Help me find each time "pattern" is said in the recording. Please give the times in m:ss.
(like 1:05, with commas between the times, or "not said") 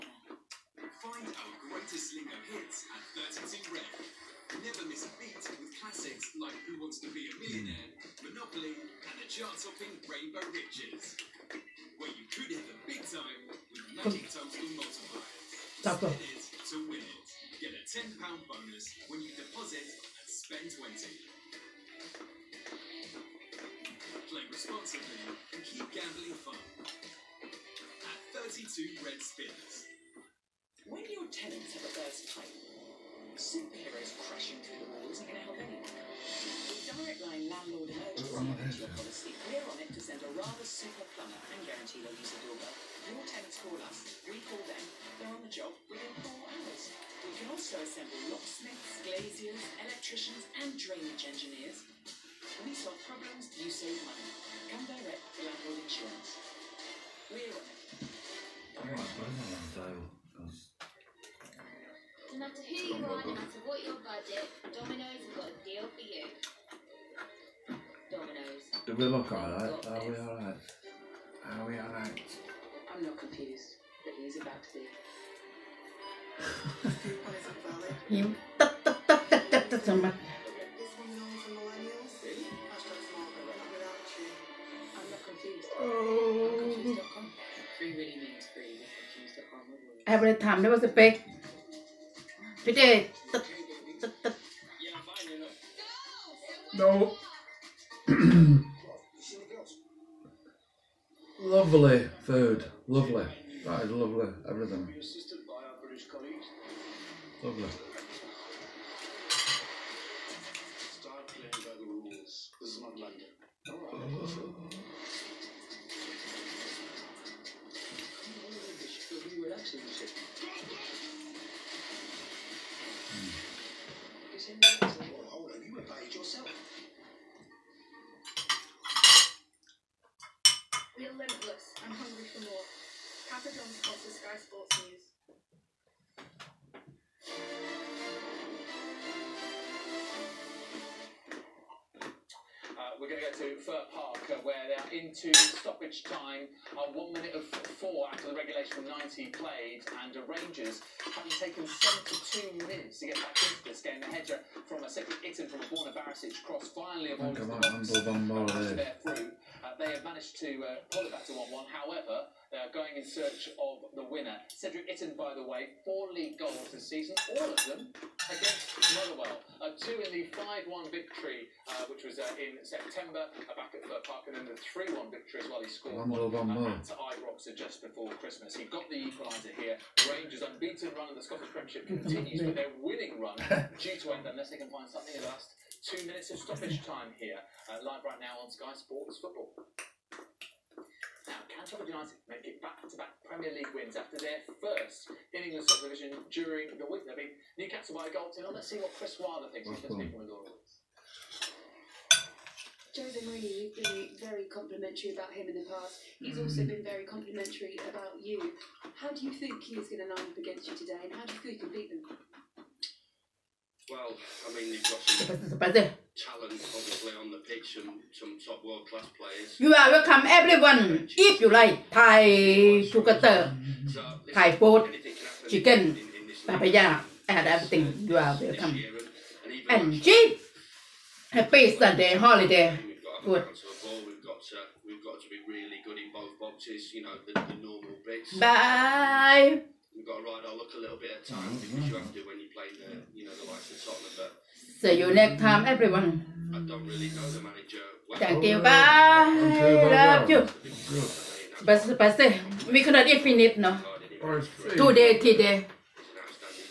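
not said.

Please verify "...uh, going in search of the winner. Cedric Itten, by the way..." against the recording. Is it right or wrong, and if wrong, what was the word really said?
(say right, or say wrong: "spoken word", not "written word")
right.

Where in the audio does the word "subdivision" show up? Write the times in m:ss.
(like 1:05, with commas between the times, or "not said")
3:15.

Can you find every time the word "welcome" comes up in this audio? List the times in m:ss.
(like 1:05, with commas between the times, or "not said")
3:39, 3:48.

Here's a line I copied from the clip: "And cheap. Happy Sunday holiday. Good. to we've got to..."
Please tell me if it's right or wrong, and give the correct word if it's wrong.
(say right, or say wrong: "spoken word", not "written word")
right.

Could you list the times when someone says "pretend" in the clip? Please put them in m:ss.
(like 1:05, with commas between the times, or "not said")
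not said.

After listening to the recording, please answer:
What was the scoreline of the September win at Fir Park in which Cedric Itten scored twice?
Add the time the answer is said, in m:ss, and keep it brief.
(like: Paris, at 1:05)
5-1, at 2:50.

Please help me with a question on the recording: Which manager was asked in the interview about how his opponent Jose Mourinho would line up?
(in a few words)
Chris Wilder.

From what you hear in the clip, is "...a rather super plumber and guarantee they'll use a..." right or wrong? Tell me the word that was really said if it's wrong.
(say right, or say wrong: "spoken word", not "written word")
right.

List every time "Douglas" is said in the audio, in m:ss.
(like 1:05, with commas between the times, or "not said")
not said.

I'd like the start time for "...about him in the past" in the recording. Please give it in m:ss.
3:25.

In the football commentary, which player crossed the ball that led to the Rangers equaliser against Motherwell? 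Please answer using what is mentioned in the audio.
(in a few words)
Borna Barisic.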